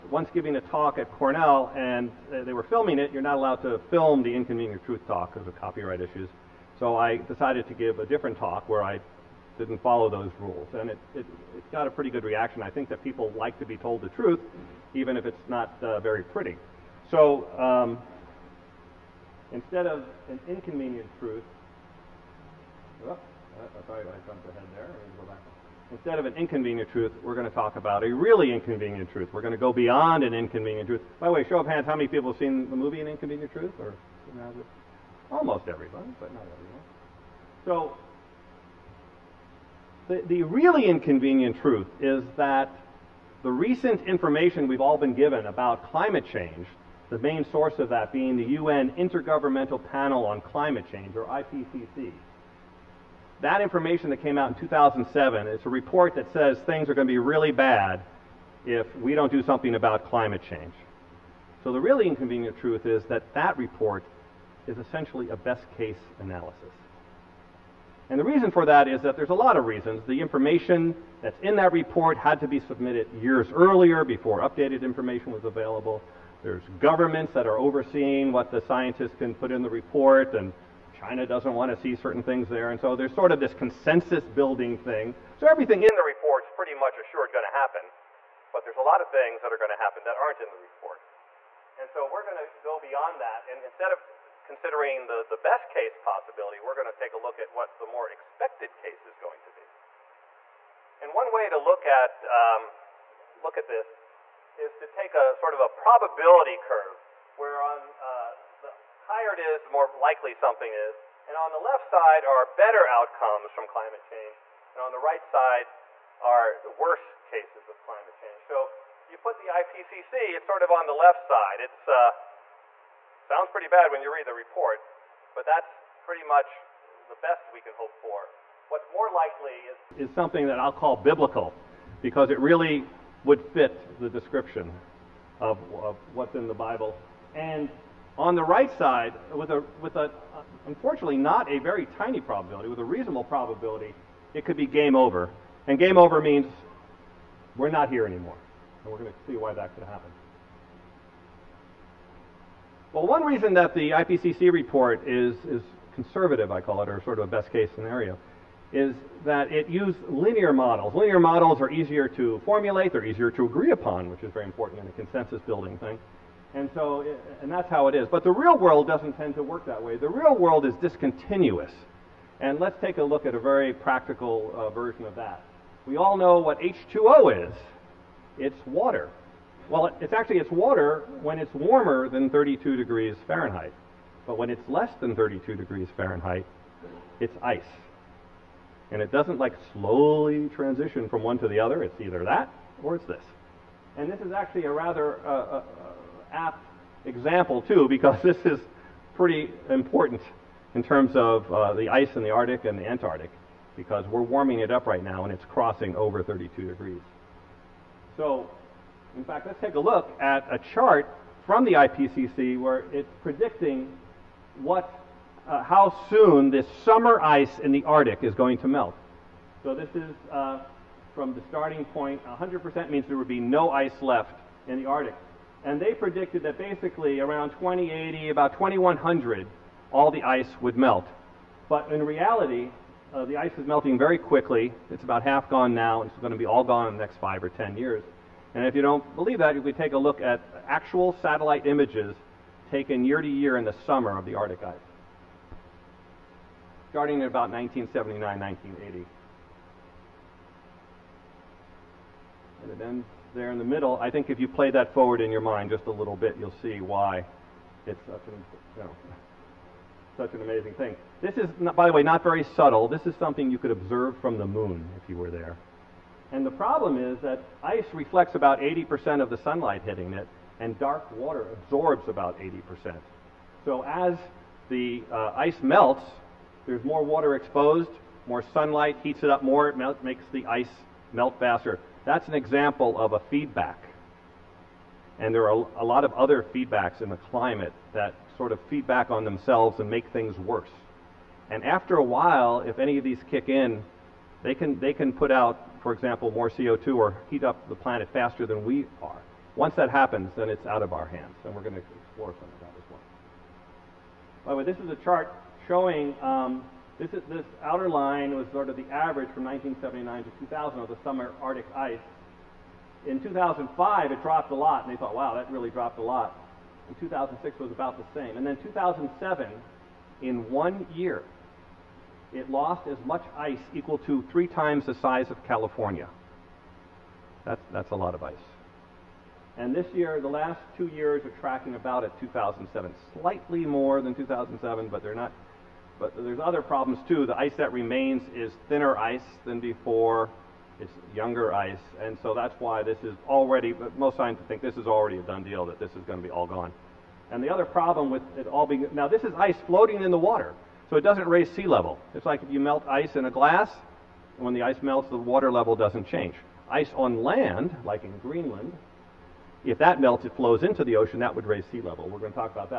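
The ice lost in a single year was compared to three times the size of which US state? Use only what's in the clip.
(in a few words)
California.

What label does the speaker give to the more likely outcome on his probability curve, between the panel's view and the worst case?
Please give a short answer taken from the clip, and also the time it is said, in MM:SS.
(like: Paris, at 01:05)
biblical, at 02:10.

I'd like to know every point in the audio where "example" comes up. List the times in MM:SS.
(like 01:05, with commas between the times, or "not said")
03:17, 04:42, 04:55.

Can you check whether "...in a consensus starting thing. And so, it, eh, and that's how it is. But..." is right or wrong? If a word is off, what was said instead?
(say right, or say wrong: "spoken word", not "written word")
wrong: "building", not "starting".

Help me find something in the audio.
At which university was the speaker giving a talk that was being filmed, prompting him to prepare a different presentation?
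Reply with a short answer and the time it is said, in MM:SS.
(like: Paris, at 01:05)
Cornell, at 00:01.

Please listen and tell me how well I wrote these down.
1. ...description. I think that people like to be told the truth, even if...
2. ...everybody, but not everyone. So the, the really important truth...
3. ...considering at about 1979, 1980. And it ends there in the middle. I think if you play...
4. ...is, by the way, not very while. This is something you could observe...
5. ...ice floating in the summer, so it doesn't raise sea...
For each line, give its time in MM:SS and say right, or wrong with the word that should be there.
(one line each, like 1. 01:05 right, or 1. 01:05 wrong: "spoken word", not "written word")
1. 00:12 wrong: "reaction", not "description"
2. 00:35 wrong: "inconvenient", not "important"
3. 04:06 wrong: "starting", not "considering"
4. 04:21 wrong: "subtle", not "while"
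5. 05:49 wrong: "water", not "summer".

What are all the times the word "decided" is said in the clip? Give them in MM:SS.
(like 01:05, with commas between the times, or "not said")
00:07.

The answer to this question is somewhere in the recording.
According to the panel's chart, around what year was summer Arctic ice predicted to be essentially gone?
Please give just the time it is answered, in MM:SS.
03:47.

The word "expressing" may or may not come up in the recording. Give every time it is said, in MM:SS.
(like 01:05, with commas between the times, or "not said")
not said.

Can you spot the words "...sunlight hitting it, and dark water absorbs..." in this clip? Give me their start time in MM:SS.
04:29.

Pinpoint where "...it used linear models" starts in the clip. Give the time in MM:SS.
02:39.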